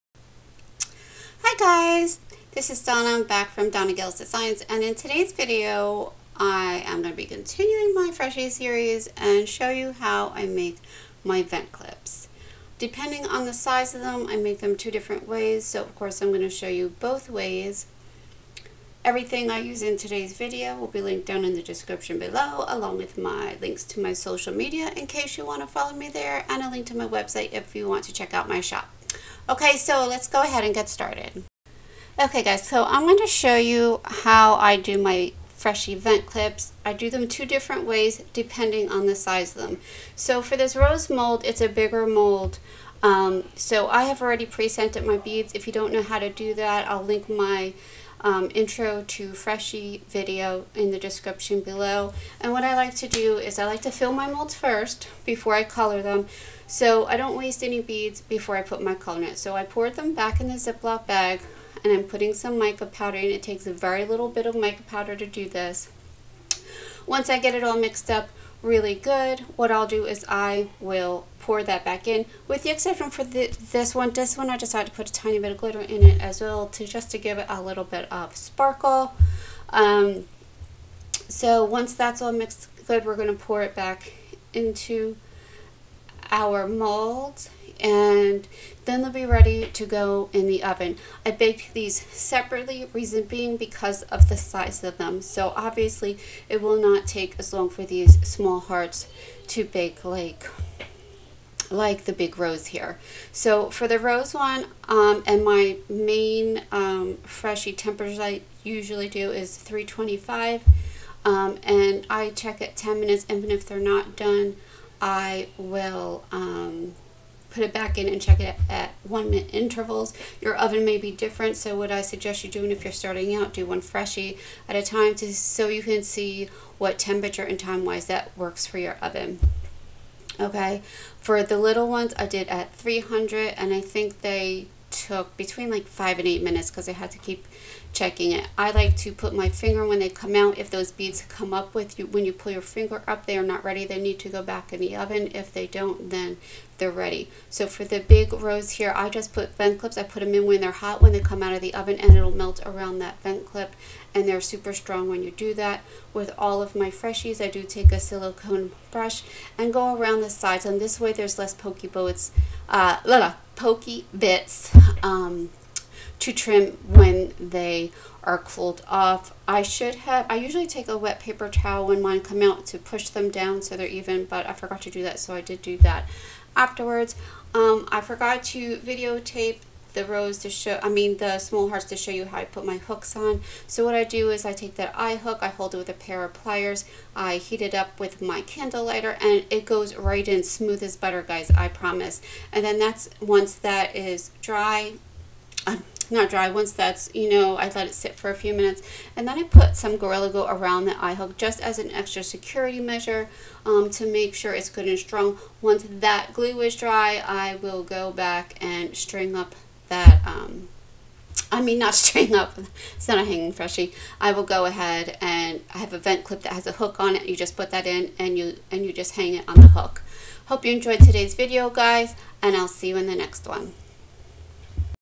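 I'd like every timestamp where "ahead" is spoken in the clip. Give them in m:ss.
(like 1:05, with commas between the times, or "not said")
0:30, 3:34.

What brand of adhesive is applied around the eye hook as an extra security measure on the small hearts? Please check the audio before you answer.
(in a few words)
Gorilla Glue.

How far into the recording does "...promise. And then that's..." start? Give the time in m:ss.
3:11.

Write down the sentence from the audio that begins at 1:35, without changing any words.
So obviously it will not take as long for these small hearts to bake like like the big rose here.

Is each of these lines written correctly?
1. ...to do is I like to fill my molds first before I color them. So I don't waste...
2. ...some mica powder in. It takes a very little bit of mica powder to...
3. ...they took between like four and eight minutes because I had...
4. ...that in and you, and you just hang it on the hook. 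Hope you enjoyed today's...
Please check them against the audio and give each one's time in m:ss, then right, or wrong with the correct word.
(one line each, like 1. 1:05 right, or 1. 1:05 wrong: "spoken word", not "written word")
1. 0:52 right
2. 1:02 right
3. 2:14 wrong: "five", not "four"
4. 3:37 right.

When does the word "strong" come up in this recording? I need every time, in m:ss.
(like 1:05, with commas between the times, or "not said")
2:34, 3:24.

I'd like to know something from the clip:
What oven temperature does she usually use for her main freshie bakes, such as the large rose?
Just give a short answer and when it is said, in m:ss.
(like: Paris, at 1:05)
325, at 1:49.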